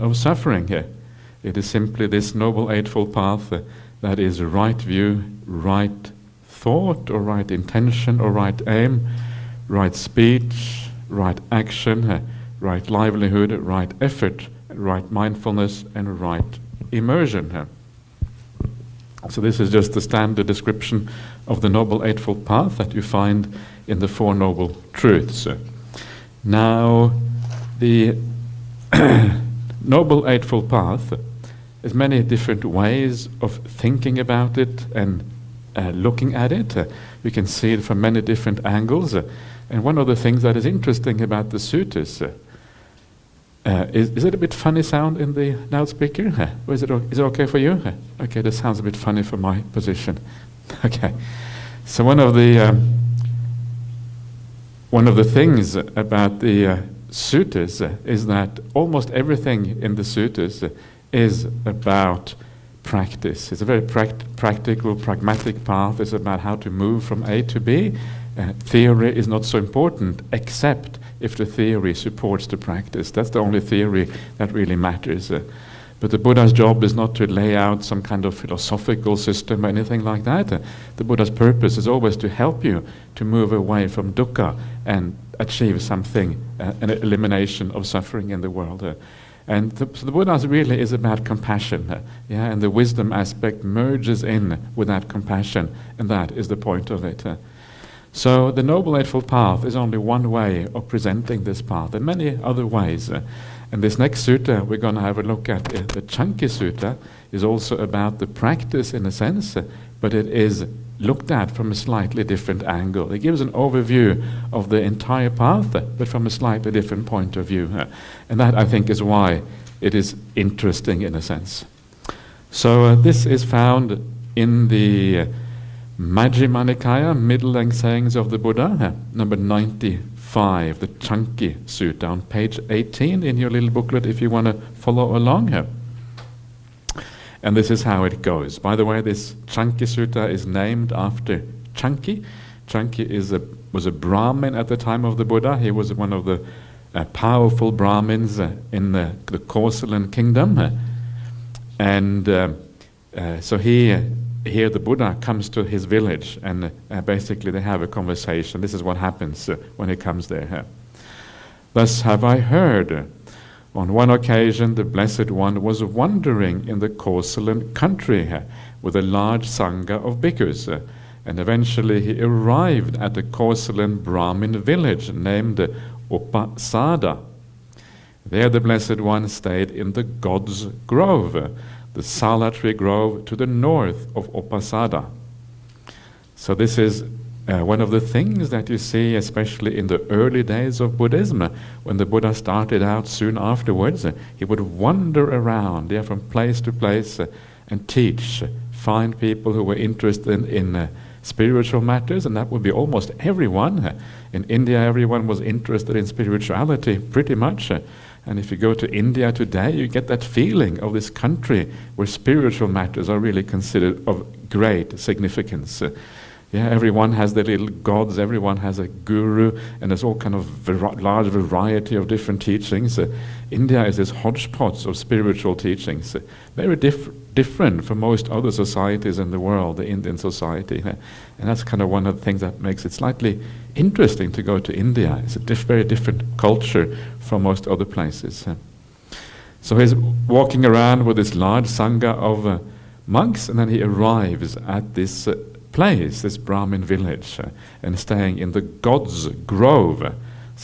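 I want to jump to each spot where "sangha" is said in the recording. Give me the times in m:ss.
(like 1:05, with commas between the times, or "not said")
2:49, 4:01.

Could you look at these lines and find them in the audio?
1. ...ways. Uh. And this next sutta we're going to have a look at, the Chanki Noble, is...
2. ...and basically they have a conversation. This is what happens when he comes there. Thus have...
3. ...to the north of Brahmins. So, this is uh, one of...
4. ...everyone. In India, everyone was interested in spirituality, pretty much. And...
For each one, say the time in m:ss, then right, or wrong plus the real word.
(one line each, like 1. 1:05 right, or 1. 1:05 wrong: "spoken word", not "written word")
1. 1:42 wrong: "Sutta", not "Noble"
2. 2:36 right
3. 3:03 wrong: "Upasada", not "Brahmins"
4. 3:23 right.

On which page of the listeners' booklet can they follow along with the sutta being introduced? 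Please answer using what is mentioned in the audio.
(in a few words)
18.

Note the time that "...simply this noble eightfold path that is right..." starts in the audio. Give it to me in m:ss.
0:01.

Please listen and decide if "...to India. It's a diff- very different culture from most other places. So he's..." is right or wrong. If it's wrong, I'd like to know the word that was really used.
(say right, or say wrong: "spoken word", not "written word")
right.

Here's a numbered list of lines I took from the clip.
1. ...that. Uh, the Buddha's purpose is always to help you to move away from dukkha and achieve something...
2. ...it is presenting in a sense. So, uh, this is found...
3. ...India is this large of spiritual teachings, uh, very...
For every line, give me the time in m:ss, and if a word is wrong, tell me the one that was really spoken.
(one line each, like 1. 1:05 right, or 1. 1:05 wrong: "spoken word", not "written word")
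1. 1:20 right
2. 1:59 wrong: "interesting", not "presenting"
3. 3:43 wrong: "hodgepodge", not "large".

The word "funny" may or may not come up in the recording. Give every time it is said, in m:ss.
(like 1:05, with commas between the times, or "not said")
0:44, 0:48.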